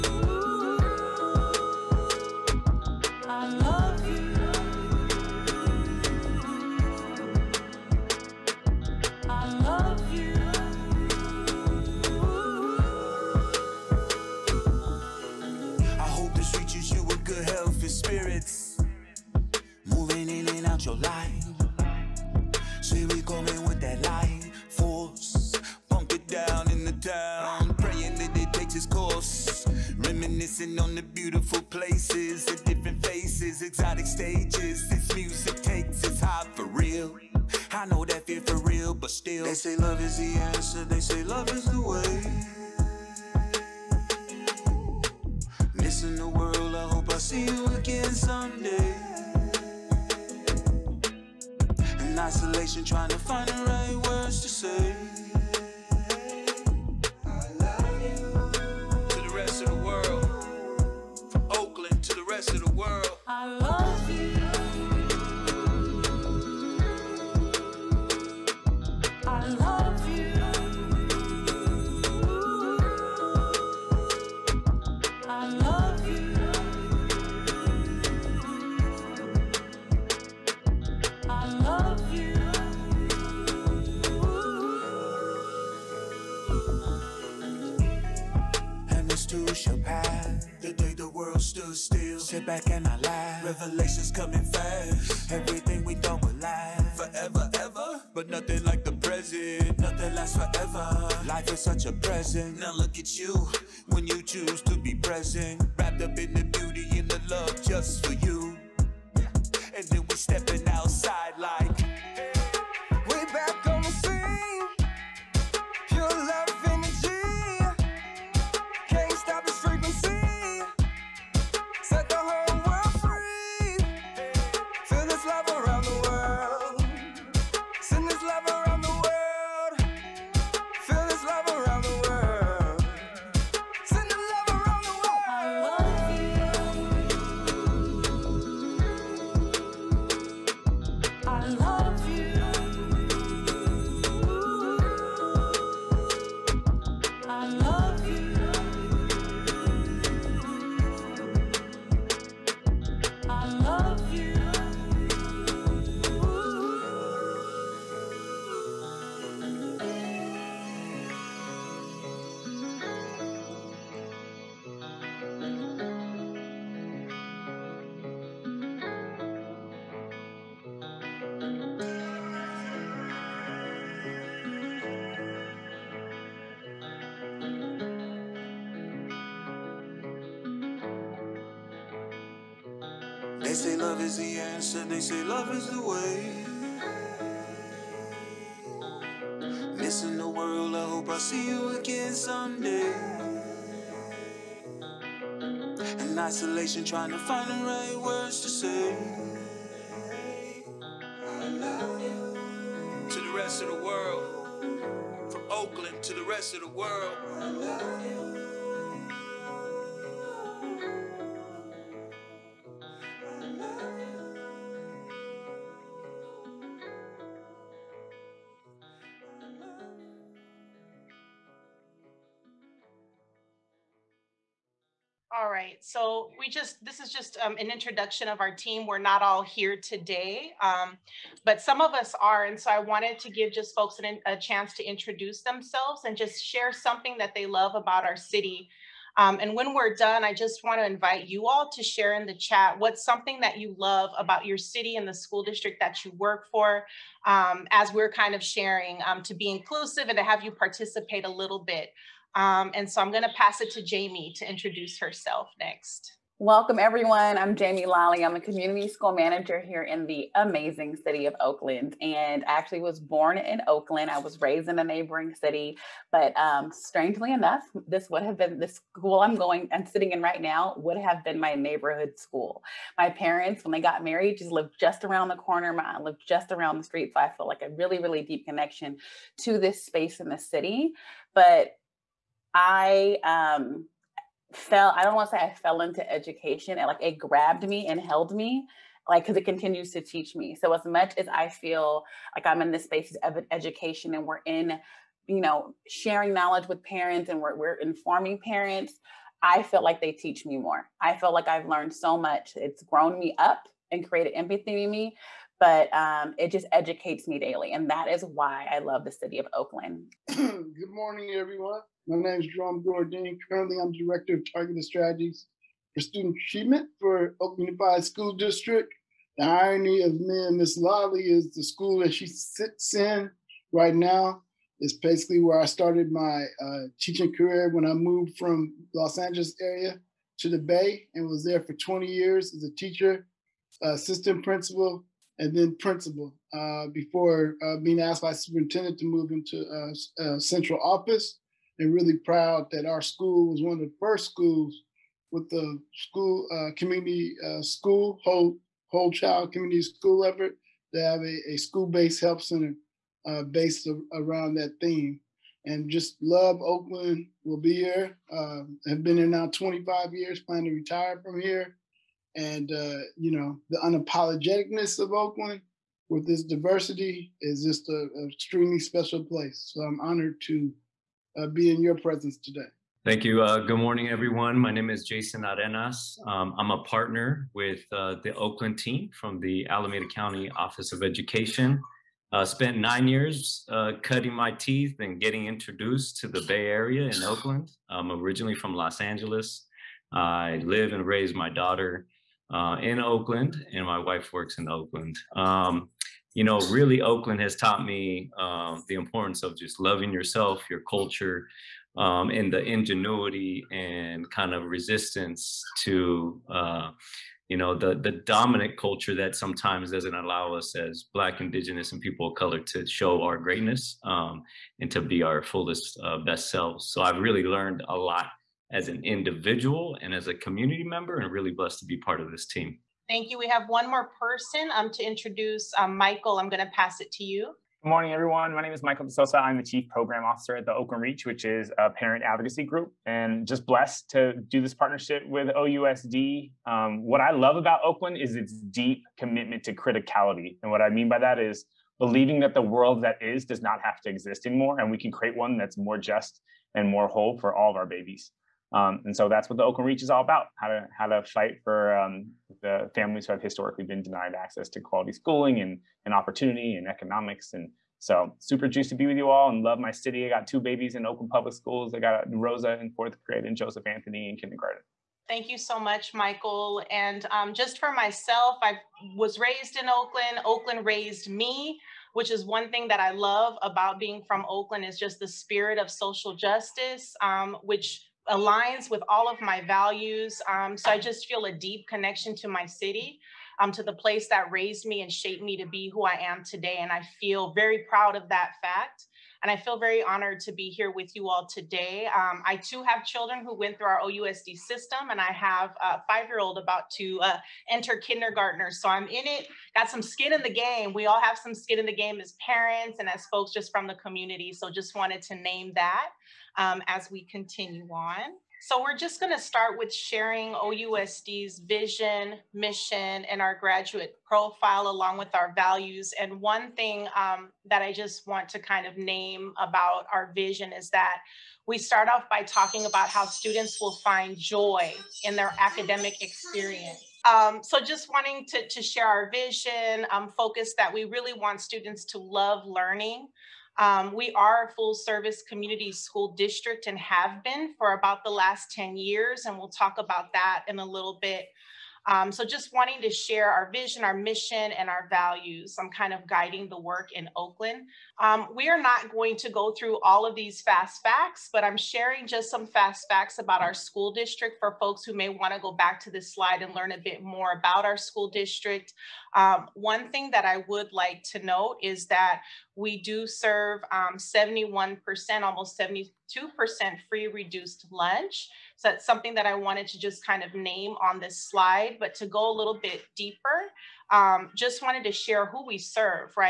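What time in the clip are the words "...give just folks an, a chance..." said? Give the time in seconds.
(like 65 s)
233 s.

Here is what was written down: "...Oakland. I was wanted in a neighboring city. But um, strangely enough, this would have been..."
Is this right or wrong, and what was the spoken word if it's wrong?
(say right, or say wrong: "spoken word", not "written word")
wrong: "raised", not "wanted".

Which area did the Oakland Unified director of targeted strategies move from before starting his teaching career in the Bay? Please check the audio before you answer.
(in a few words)
Los Angeles area.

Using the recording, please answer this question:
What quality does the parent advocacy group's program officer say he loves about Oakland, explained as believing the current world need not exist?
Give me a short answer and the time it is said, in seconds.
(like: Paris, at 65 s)
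Criticality, at 439 s.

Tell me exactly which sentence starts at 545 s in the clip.
I'm kind of guiding the work in Oakland.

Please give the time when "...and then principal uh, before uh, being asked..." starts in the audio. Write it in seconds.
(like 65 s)
335 s.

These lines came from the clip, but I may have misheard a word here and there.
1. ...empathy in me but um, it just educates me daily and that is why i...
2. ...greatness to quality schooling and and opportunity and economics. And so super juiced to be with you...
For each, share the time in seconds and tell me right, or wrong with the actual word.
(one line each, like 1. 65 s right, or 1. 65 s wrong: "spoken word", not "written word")
1. 304 s right
2. 454 s wrong: "access", not "greatness".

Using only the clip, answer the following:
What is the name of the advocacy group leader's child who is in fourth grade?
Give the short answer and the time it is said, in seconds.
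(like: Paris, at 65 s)
Rosa, at 462 s.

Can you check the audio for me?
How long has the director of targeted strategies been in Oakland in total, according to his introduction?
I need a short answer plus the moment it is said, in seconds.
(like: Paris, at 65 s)
25 years, at 359 s.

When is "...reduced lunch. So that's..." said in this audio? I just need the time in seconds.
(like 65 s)
567 s.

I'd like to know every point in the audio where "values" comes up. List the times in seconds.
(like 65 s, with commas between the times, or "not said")
479 s, 515 s, 545 s.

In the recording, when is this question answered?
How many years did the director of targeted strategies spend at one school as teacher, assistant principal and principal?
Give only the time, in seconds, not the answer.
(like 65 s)
331 s.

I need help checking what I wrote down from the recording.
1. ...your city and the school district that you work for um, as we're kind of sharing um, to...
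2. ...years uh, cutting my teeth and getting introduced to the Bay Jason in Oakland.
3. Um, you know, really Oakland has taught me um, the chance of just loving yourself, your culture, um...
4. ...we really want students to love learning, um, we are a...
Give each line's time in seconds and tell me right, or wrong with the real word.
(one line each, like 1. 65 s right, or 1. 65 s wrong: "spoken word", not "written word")
1. 244 s right
2. 383 s wrong: "Area", not "Jason"
3. 395 s wrong: "importance", not "chance"
4. 530 s right.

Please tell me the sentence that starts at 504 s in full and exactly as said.
So just wanted to name that um, as we continue on.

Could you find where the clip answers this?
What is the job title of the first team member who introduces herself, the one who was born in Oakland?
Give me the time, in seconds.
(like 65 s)
258 s.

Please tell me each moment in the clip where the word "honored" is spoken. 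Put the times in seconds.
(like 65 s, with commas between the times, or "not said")
369 s, 490 s.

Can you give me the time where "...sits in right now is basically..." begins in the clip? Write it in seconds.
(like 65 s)
322 s.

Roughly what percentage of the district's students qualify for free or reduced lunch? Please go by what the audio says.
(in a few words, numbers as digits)
71%.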